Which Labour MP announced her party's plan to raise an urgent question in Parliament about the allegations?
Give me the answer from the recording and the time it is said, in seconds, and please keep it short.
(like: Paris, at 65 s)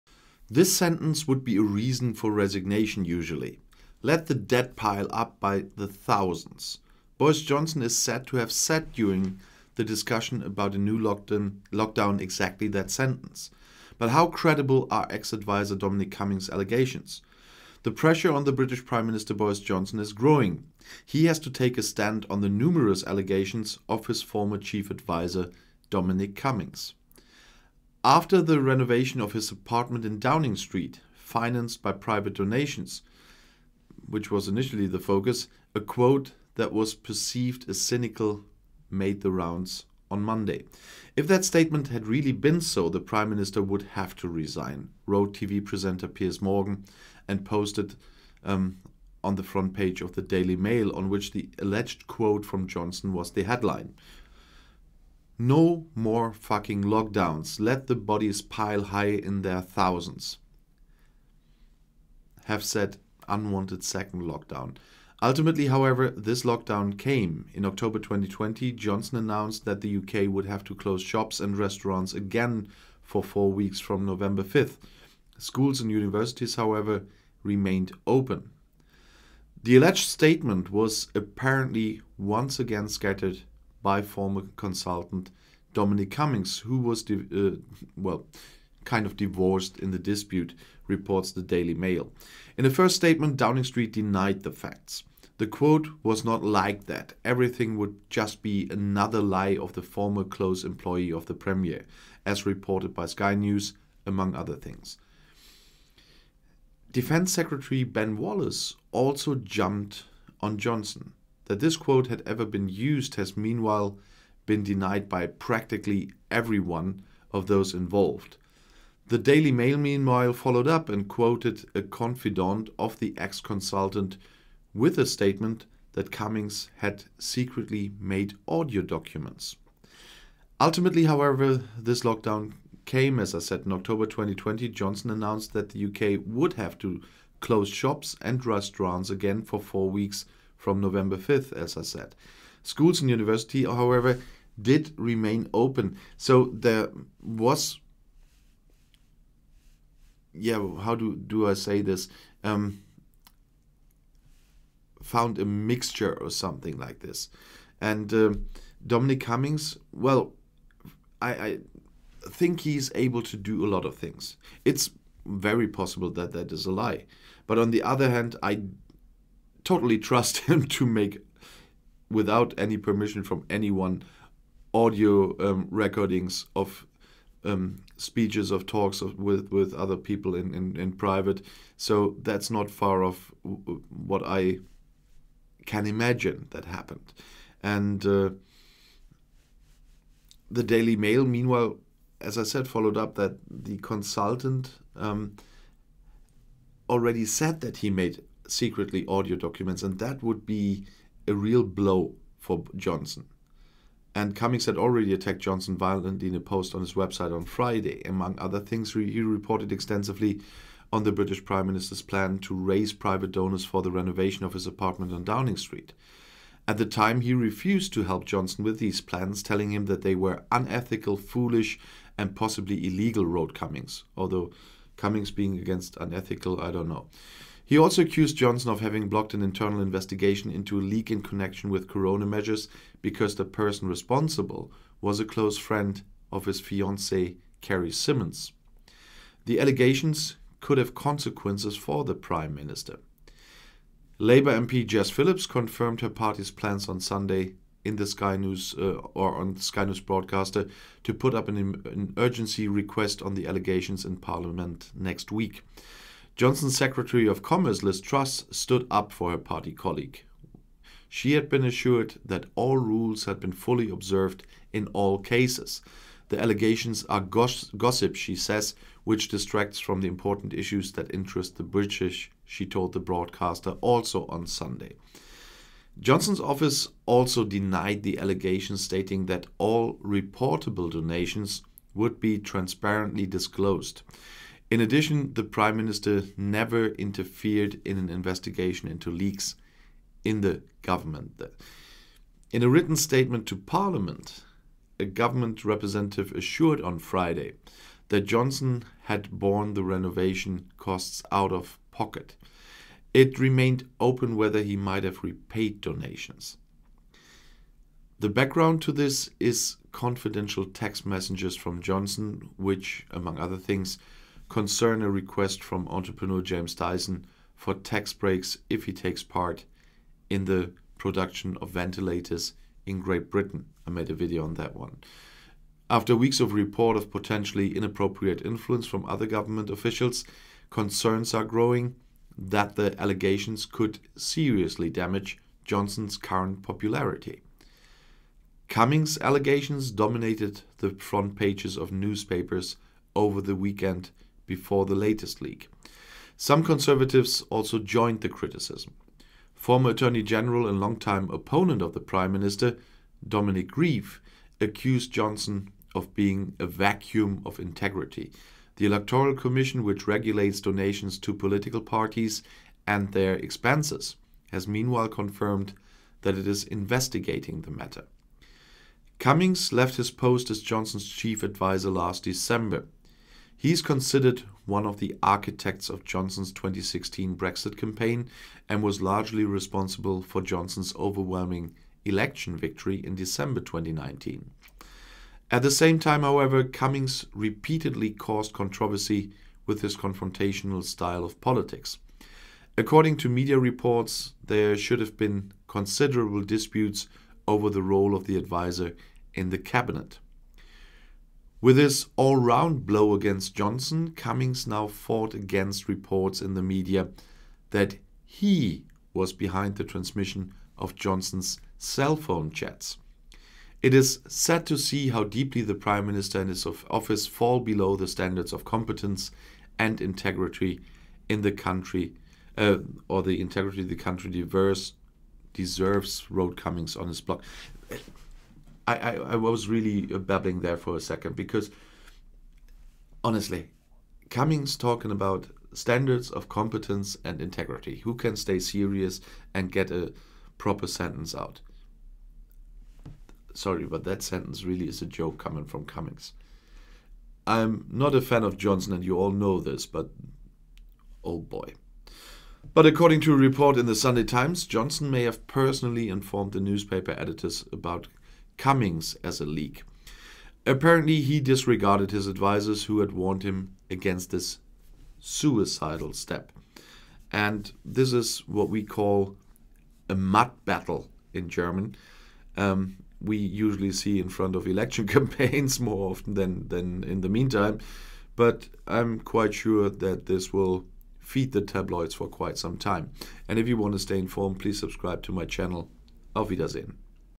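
Jess Phillips, at 244 s.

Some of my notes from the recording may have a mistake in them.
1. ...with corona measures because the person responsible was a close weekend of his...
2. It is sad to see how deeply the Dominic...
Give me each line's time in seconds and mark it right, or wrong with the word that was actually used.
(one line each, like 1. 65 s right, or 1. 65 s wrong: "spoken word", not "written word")
1. 231 s wrong: "friend", not "weekend"
2. 413 s wrong: "Prime", not "Dominic".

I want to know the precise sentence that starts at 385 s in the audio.
At the same time, however, Cummings repeatedly caused controversy with his confrontational style of politics.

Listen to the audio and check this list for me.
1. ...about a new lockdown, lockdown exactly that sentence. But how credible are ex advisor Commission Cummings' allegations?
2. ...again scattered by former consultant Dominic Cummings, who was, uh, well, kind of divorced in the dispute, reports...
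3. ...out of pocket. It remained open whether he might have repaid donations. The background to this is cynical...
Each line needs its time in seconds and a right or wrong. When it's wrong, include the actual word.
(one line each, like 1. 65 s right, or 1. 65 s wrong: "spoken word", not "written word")
1. 10 s wrong: "Dominic", not "Commission"
2. 82 s right
3. 301 s wrong: "confidential", not "cynical".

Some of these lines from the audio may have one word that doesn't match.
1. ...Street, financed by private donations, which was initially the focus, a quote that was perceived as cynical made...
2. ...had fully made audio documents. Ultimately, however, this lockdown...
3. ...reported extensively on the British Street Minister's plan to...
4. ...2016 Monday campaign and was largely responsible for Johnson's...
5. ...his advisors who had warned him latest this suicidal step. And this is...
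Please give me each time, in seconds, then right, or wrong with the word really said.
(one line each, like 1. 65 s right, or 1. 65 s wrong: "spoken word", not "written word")
1. 30 s right
2. 126 s wrong: "secretly", not "fully"
3. 209 s wrong: "Prime", not "Street"
4. 376 s wrong: "Brexit", not "Monday"
5. 462 s wrong: "against", not "latest".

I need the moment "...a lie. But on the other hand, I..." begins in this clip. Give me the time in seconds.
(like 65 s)
166 s.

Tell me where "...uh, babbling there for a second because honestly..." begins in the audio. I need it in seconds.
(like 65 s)
430 s.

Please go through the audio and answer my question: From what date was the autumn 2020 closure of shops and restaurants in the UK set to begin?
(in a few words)
November 5th.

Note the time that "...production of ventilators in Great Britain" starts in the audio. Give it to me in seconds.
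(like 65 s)
320 s.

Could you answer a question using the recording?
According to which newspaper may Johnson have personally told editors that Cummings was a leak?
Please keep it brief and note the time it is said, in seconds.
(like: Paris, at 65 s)
Sunday Times, at 453 s.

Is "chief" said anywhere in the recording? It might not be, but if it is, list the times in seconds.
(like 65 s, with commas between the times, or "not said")
24 s, 371 s.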